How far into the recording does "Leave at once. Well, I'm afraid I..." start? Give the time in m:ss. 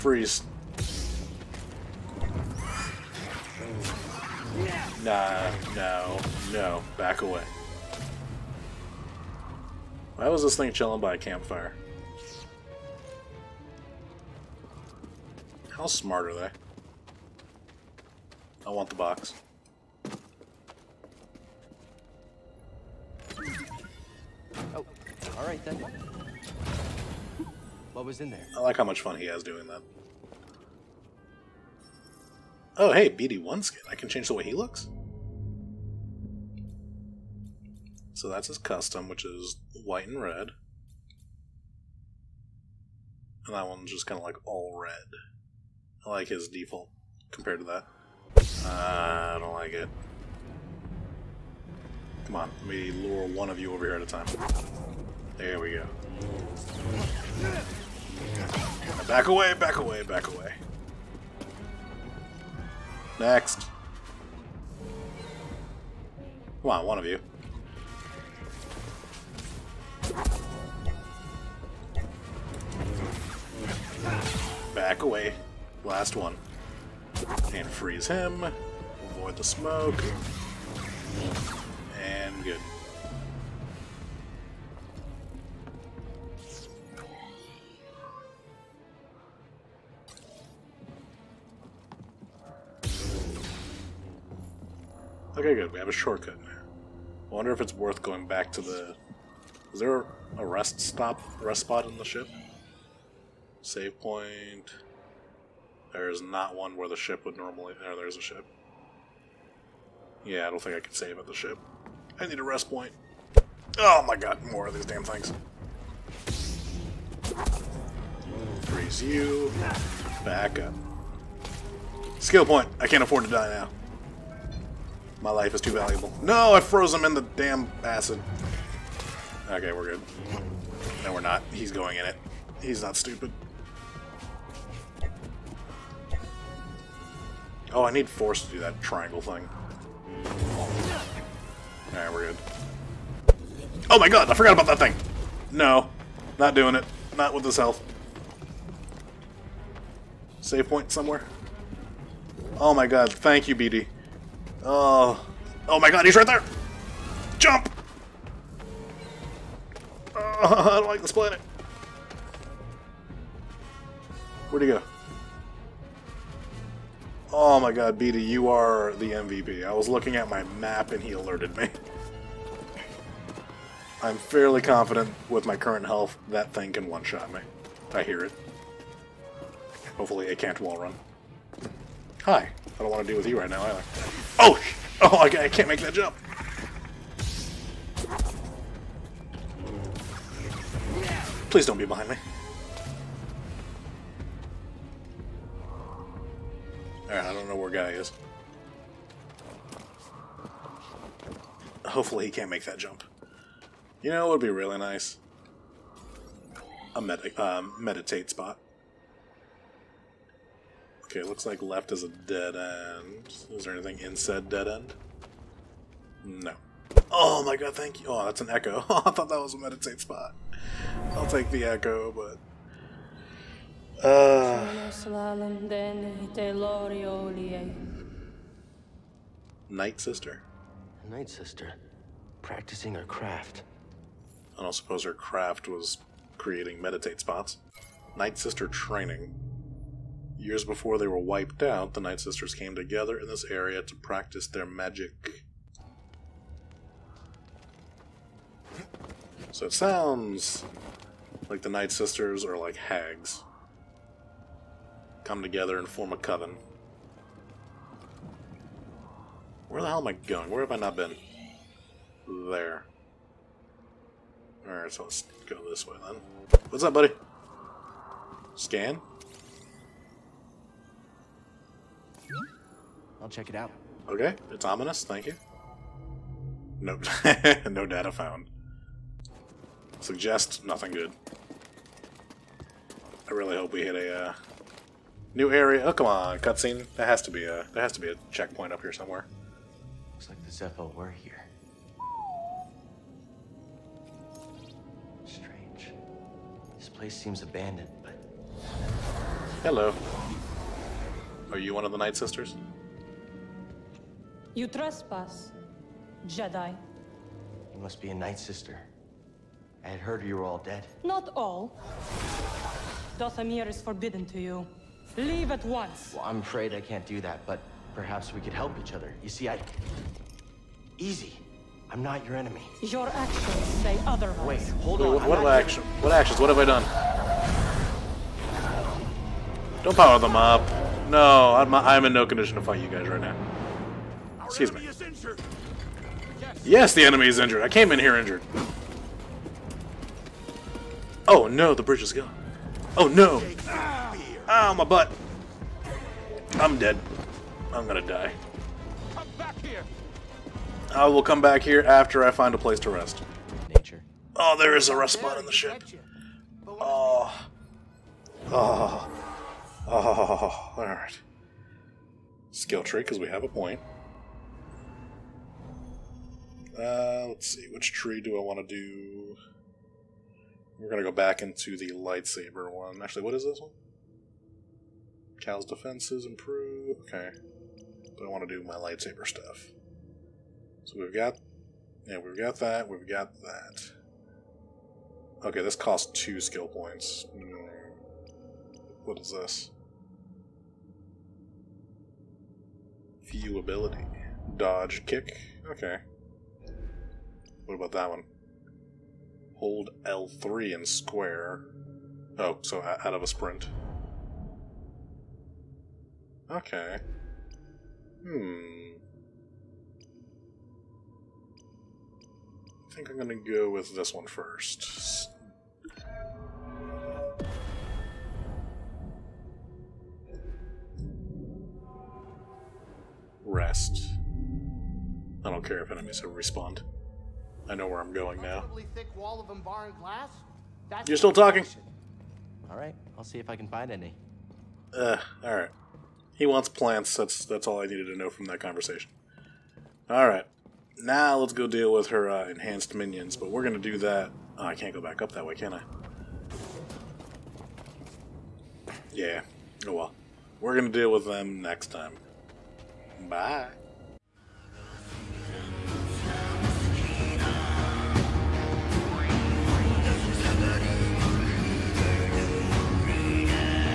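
5:15.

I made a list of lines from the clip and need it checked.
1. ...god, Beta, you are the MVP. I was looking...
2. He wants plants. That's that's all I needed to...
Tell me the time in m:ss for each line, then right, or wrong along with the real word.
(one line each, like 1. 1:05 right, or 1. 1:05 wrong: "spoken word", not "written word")
1. 2:47 right
2. 7:16 right.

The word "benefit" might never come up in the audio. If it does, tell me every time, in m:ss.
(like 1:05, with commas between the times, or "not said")
not said.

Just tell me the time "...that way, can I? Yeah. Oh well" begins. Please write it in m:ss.
7:25.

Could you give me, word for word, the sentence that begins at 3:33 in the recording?
Is there anything in said dead end?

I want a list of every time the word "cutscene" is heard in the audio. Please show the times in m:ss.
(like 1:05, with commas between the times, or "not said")
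4:46.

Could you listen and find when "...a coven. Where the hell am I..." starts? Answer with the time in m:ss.
4:16.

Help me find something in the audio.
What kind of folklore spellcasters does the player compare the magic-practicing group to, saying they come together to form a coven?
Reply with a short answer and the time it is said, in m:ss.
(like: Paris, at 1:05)
Hags, at 4:12.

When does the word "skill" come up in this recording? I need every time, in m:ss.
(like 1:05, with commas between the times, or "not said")
2:02, 6:02, 6:26.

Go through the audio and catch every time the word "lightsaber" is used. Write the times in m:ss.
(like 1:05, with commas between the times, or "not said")
6:11, 6:18.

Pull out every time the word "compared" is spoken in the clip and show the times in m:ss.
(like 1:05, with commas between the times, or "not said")
0:47.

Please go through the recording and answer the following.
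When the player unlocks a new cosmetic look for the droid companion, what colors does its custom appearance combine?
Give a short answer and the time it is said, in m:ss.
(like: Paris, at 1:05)
White and red, at 0:39.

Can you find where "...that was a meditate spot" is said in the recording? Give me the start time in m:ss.
3:39.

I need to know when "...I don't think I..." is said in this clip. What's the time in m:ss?
1:50.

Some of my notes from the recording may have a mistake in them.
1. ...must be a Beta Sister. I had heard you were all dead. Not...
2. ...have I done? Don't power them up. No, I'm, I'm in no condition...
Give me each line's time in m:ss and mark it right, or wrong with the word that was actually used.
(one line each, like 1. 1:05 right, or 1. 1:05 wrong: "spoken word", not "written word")
1. 5:07 wrong: "Night", not "Beta"
2. 5:26 right.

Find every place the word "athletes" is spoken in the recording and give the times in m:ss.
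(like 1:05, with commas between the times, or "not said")
not said.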